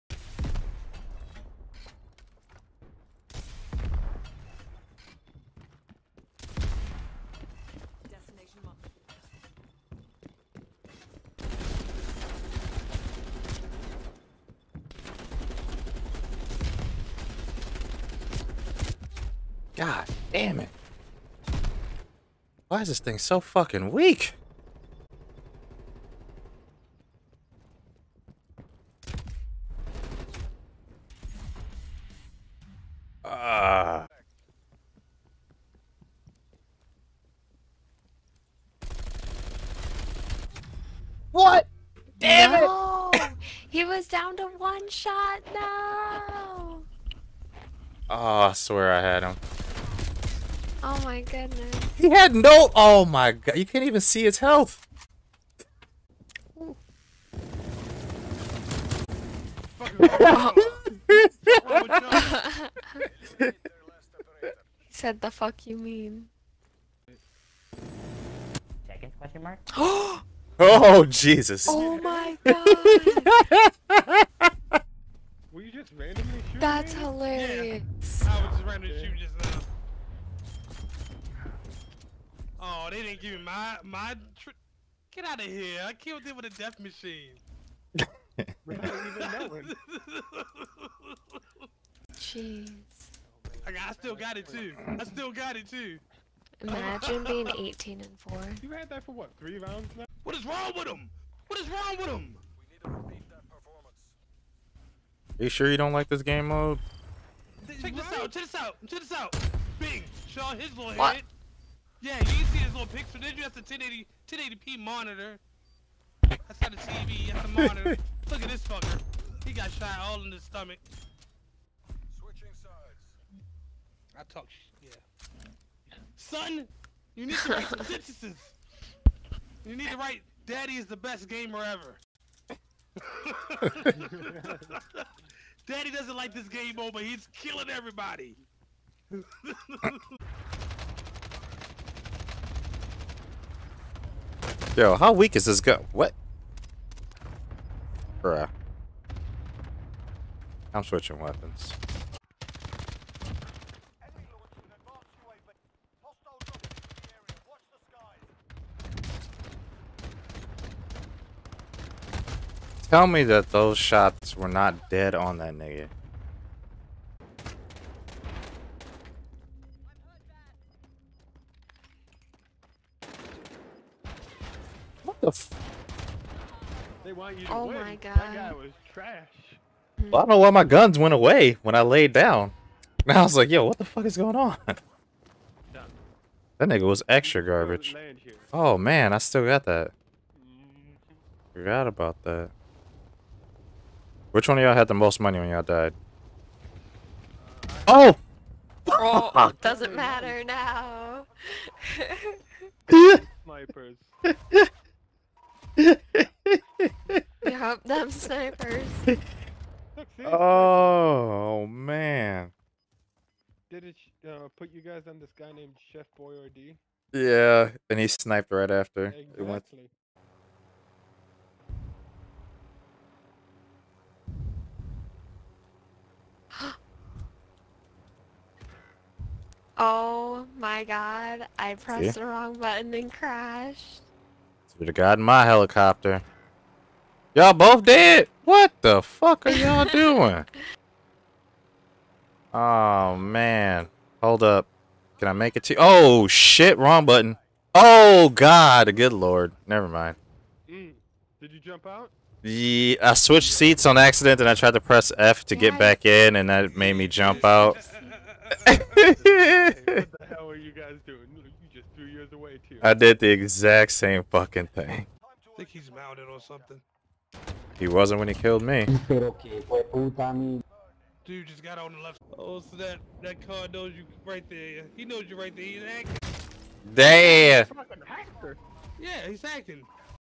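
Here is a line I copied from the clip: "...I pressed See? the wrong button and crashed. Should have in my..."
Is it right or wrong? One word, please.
right.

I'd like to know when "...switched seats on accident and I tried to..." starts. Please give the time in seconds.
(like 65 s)
253 s.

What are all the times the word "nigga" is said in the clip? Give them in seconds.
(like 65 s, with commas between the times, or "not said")
165 s, 186 s.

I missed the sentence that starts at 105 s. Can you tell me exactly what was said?
You sure you don't like this game mode?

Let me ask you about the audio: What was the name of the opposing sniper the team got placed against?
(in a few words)
Chef Boyardee.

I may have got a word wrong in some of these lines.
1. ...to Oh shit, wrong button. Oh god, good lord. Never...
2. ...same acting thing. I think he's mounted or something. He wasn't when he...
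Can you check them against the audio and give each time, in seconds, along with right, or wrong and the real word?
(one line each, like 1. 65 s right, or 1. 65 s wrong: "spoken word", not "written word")
1. 245 s right
2. 263 s wrong: "fucking", not "acting".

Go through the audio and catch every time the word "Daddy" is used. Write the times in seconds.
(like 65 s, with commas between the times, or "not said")
130 s, 135 s.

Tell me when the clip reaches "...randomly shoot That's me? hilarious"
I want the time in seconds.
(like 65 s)
75 s.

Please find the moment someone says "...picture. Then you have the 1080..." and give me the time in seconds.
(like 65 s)
112 s.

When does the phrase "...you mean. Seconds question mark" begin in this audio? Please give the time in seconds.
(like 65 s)
65 s.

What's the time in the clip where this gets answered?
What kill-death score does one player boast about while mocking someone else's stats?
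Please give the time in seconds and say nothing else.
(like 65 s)
97 s.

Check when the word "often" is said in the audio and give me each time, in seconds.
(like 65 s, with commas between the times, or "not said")
not said.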